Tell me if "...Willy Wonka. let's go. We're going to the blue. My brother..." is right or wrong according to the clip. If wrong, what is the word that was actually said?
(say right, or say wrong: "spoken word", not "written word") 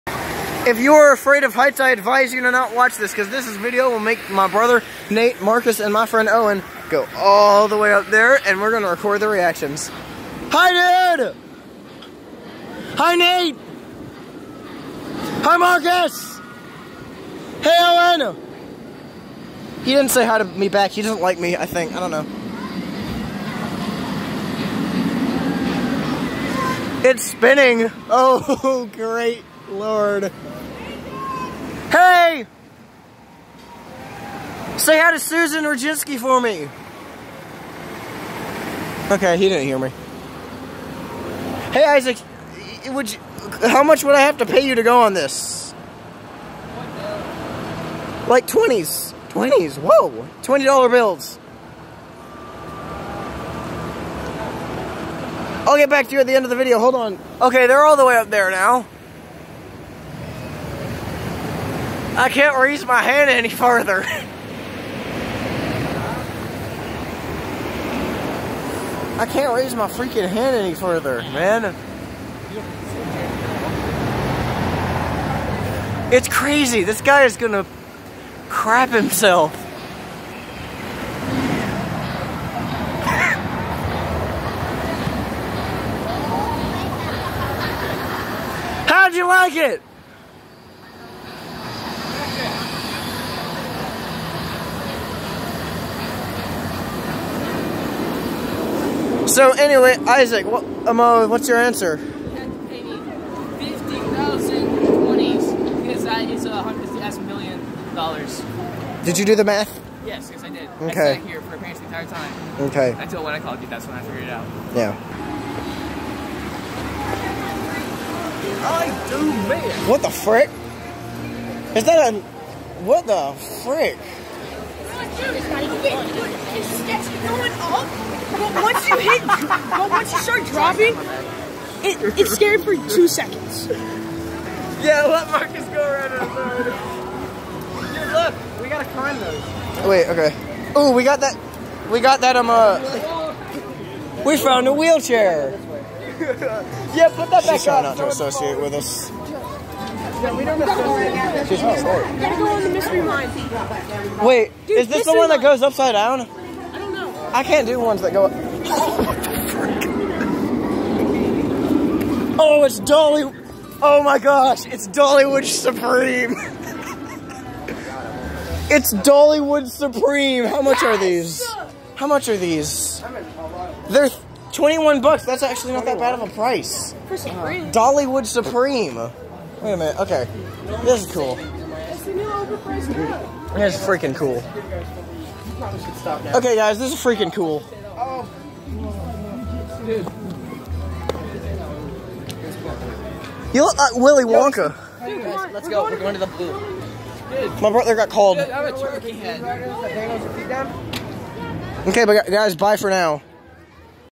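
right.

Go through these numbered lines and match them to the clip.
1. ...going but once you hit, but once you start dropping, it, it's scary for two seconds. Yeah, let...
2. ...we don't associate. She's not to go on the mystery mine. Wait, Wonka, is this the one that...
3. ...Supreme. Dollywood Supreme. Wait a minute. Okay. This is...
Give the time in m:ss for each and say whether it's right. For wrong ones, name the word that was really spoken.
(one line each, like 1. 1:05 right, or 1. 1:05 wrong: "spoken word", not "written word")
1. 2:07 right
2. 2:30 wrong: "Dude", not "Wonka"
3. 2:57 right.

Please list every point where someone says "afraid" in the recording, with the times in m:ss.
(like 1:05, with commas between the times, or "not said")
0:01.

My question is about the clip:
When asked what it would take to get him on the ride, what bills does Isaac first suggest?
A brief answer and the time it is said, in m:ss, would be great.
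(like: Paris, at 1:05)
20s, at 0:48.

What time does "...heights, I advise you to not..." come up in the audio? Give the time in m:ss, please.
0:01.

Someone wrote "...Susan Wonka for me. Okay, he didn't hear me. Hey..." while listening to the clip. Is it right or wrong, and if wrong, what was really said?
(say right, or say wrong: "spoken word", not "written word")
wrong: "Roginski", not "Wonka".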